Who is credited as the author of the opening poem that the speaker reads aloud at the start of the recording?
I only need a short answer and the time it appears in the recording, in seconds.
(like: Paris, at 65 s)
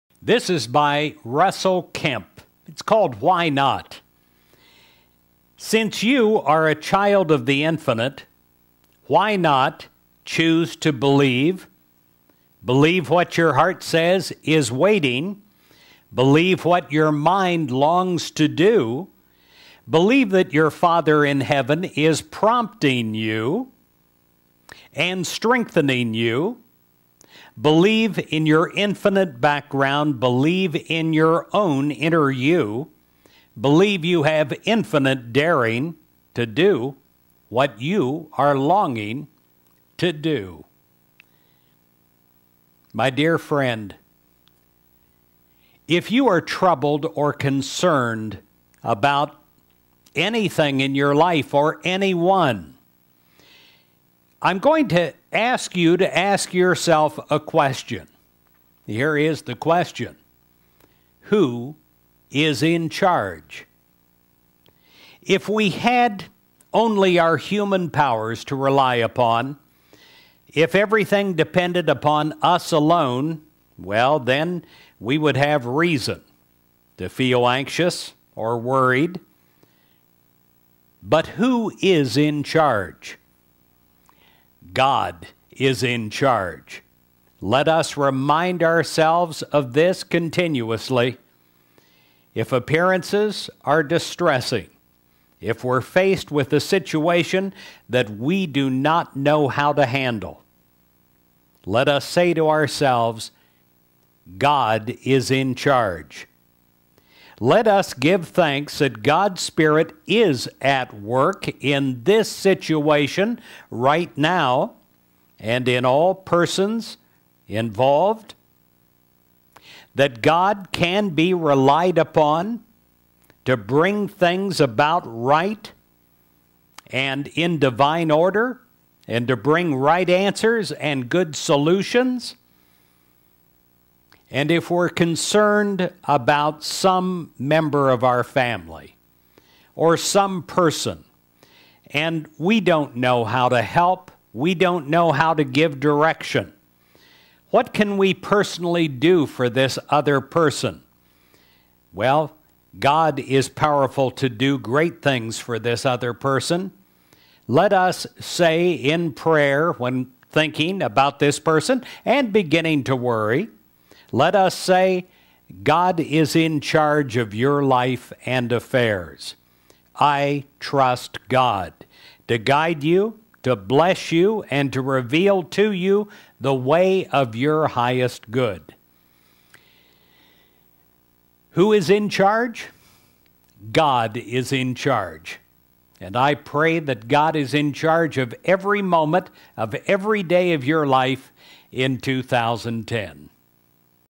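Russell Kemp, at 1 s.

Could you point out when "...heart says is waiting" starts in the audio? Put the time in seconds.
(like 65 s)
13 s.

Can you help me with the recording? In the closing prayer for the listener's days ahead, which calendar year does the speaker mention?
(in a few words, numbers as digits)
2010.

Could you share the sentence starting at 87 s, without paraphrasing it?
Let us remind ourselves of this continuously.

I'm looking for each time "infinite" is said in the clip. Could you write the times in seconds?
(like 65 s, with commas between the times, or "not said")
7 s, 28 s, 34 s.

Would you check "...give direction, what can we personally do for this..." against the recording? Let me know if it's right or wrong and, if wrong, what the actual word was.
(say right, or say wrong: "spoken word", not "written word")
right.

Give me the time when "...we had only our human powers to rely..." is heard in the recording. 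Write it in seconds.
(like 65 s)
65 s.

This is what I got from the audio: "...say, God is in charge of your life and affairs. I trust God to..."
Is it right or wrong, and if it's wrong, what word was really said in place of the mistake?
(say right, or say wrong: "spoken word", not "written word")
right.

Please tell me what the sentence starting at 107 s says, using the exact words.
Let us give thanks that God's Spirit is at work in this situation right now and in all persons involved.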